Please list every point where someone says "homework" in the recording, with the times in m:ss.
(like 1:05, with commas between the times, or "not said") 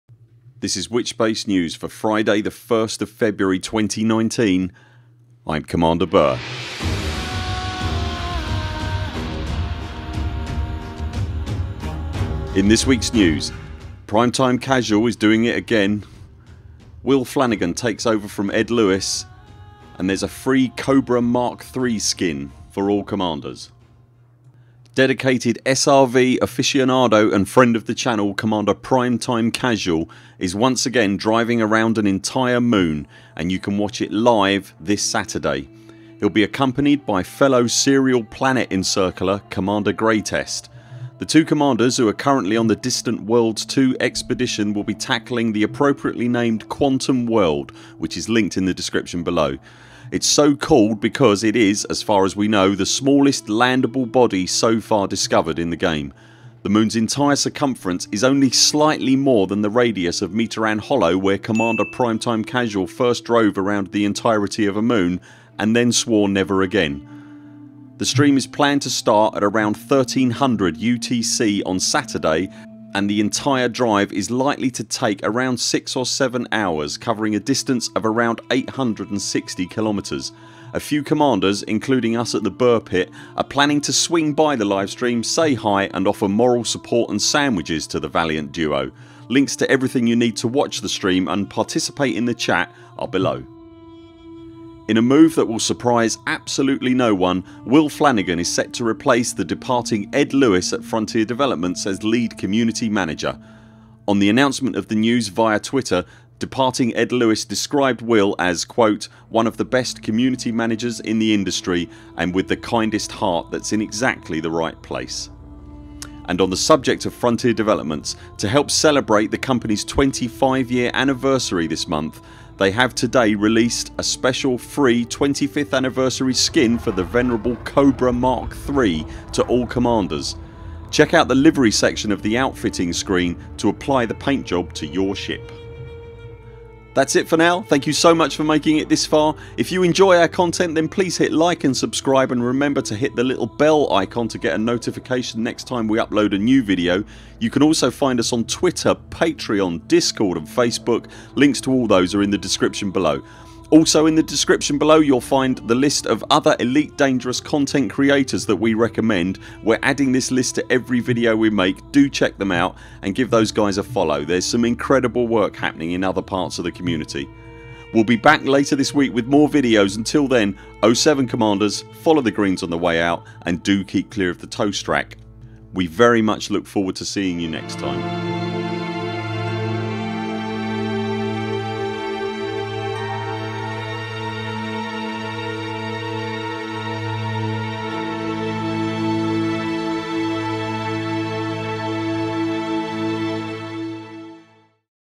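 not said.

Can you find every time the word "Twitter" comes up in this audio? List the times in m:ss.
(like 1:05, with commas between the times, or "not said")
1:45, 2:28.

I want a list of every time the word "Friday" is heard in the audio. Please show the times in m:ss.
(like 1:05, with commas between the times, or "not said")
0:01.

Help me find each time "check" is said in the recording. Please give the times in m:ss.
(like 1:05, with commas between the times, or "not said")
2:10, 2:42.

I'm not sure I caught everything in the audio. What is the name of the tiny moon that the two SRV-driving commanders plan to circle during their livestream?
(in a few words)
Quantum World.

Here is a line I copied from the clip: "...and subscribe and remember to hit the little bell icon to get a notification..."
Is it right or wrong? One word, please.
right.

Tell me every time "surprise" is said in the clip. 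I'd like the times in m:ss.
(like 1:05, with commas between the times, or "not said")
1:35.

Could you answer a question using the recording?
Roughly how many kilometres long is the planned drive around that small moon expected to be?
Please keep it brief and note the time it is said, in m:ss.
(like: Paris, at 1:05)
860, at 1:18.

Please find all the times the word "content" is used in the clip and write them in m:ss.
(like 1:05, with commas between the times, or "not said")
2:20, 2:37.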